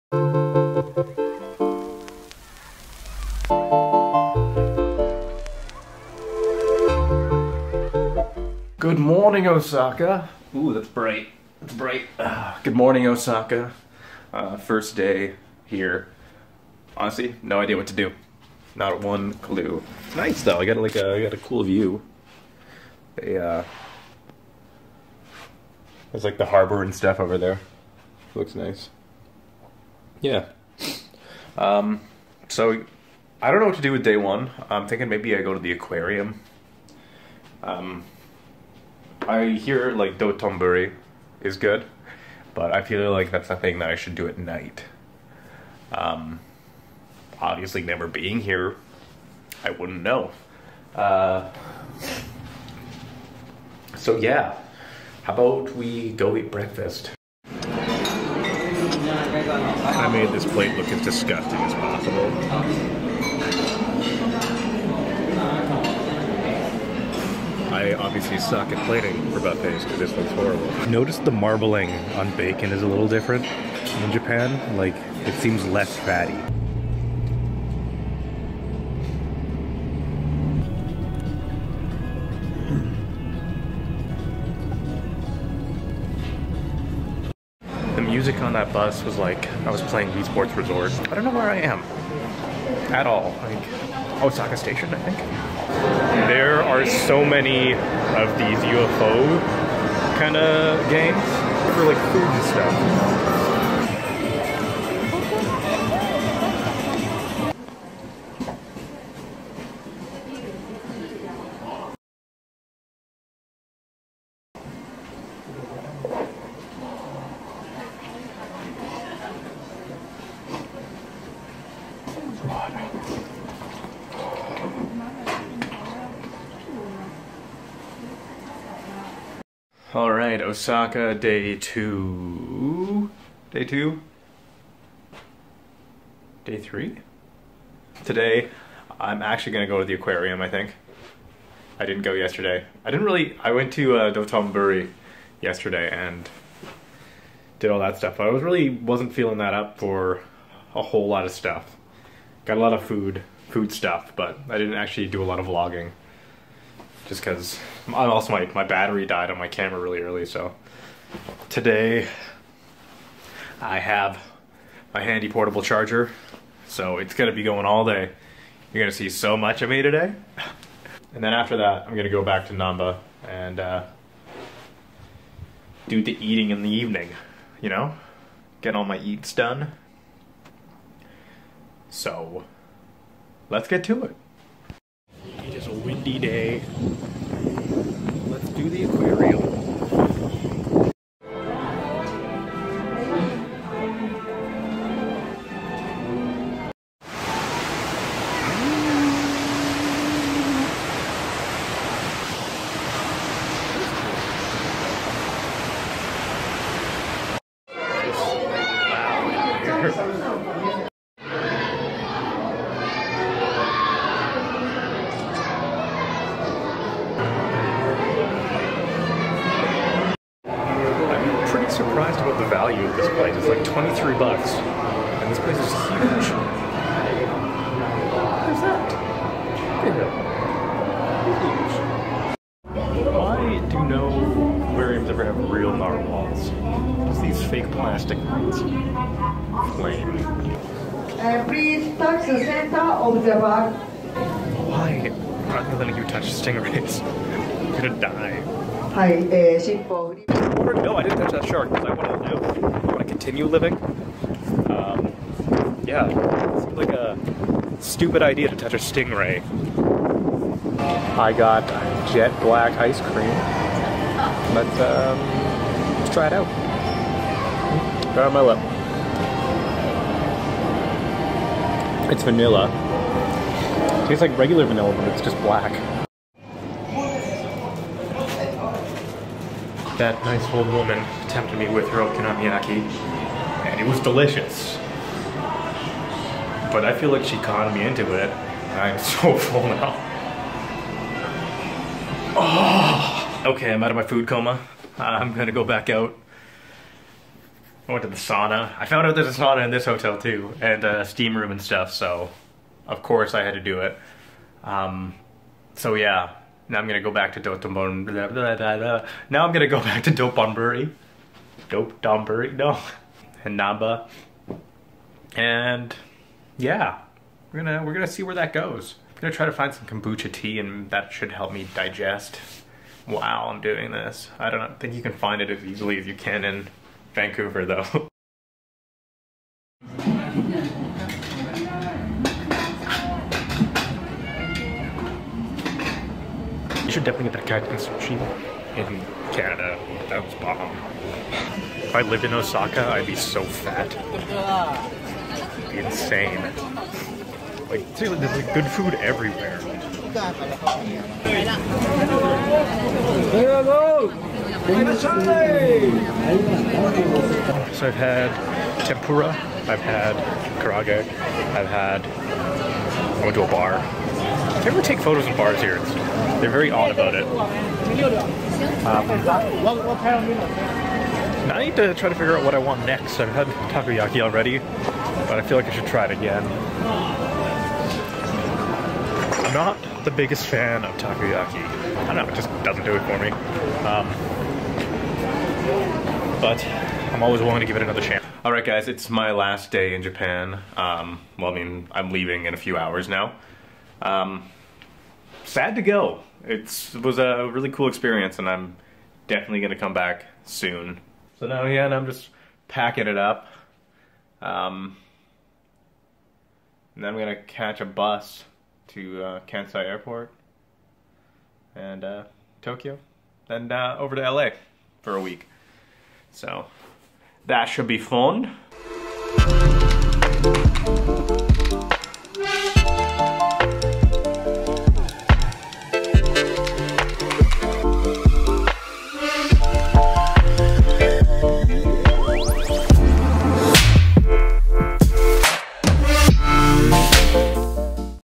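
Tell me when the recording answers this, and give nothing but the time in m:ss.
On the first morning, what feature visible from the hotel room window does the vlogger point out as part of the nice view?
0:26.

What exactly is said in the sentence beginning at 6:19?
I'm not the biggest fan of takoyaki.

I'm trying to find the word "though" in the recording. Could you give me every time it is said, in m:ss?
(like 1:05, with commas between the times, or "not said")
0:20, 5:27.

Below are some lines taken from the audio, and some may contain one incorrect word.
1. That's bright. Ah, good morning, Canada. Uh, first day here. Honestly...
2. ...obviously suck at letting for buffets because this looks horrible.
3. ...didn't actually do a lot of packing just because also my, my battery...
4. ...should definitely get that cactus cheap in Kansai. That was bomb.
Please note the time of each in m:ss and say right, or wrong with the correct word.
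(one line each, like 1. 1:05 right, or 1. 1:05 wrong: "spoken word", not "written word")
1. 0:11 wrong: "Osaka", not "Canada"
2. 1:07 wrong: "plating", not "letting"
3. 2:34 wrong: "vlogging", not "packing"
4. 5:36 wrong: "Canada", not "Kansai".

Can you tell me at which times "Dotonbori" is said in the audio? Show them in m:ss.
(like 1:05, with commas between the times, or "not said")
0:40, 5:07.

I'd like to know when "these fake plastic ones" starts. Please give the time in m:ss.
3:57.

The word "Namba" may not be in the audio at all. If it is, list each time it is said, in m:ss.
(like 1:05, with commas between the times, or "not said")
2:52, 5:13.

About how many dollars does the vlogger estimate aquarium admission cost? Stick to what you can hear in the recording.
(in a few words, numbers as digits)
23 dollars.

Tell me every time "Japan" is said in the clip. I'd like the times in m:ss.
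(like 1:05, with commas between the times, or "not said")
1:14, 6:30.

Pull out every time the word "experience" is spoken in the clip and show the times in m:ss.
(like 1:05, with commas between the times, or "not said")
6:37.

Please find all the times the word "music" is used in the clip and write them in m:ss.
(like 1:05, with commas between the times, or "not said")
1:28.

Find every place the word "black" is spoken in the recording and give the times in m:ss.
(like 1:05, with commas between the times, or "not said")
4:22, 4:35.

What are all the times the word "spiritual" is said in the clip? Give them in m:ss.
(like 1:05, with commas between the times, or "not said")
not said.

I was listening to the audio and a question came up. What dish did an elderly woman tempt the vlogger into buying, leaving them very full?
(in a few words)
okonomiyaki.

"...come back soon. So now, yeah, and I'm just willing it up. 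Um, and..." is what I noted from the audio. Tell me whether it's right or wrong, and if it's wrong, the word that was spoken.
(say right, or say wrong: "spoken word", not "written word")
wrong: "packing", not "willing".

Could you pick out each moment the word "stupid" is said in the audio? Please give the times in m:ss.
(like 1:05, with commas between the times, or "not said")
4:17.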